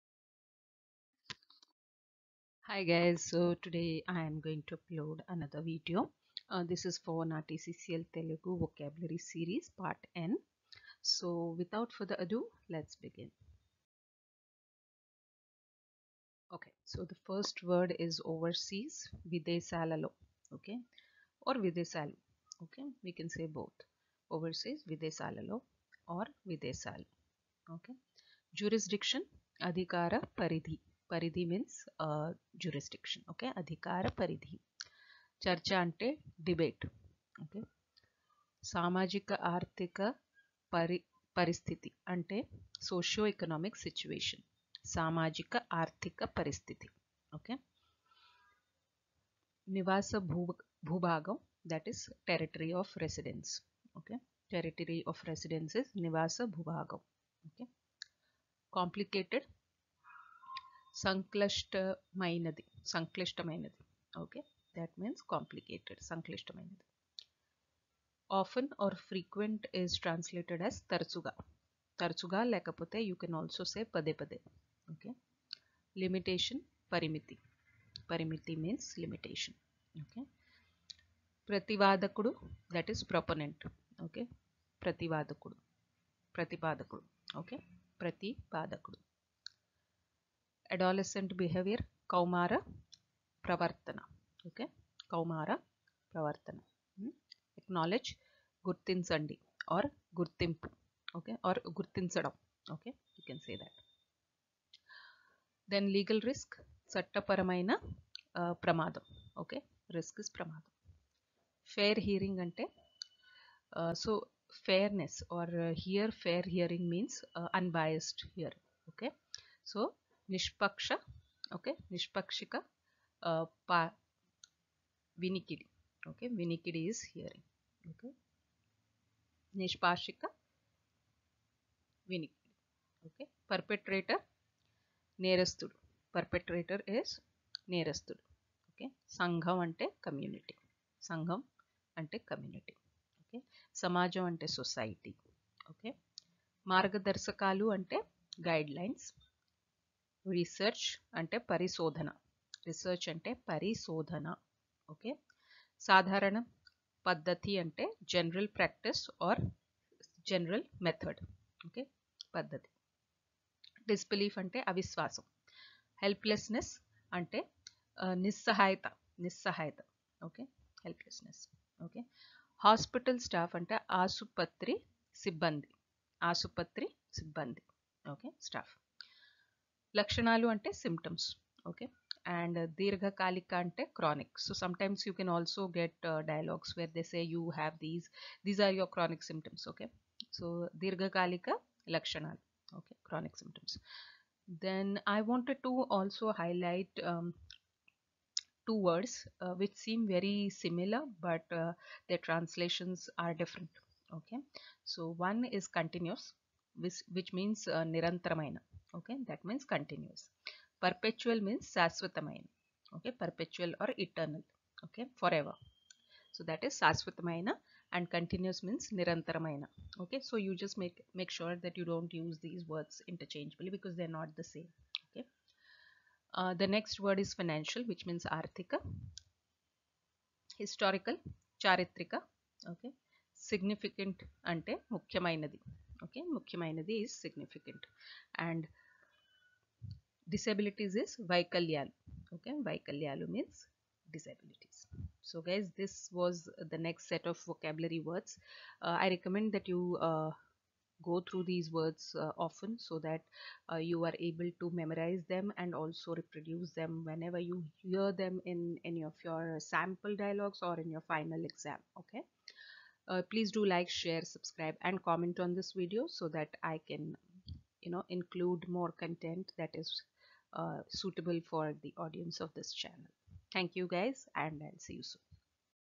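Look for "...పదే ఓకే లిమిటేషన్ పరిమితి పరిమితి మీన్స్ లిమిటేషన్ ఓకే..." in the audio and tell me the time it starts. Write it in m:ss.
1:14.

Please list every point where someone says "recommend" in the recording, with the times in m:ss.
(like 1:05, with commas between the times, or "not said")
4:09.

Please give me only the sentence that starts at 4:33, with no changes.
Thank you guys and I'll see you soon.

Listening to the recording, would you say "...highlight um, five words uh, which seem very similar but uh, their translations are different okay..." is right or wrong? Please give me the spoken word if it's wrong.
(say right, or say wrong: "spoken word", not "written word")
wrong: "two", not "five".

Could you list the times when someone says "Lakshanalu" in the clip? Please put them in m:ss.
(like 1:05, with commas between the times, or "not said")
2:59, 3:11.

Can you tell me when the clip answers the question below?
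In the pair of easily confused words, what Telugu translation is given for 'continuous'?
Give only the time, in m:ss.
3:38.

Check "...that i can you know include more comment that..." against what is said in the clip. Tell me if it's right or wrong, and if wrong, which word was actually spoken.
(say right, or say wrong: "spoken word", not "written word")
wrong: "content", not "comment".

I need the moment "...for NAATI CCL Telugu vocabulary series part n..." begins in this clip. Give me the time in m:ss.
0:07.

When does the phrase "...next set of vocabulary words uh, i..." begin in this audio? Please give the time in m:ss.
4:06.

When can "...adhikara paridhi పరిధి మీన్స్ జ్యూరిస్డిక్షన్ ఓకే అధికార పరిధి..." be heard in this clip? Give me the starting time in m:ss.
0:29.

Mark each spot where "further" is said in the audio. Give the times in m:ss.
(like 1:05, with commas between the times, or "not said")
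0:11.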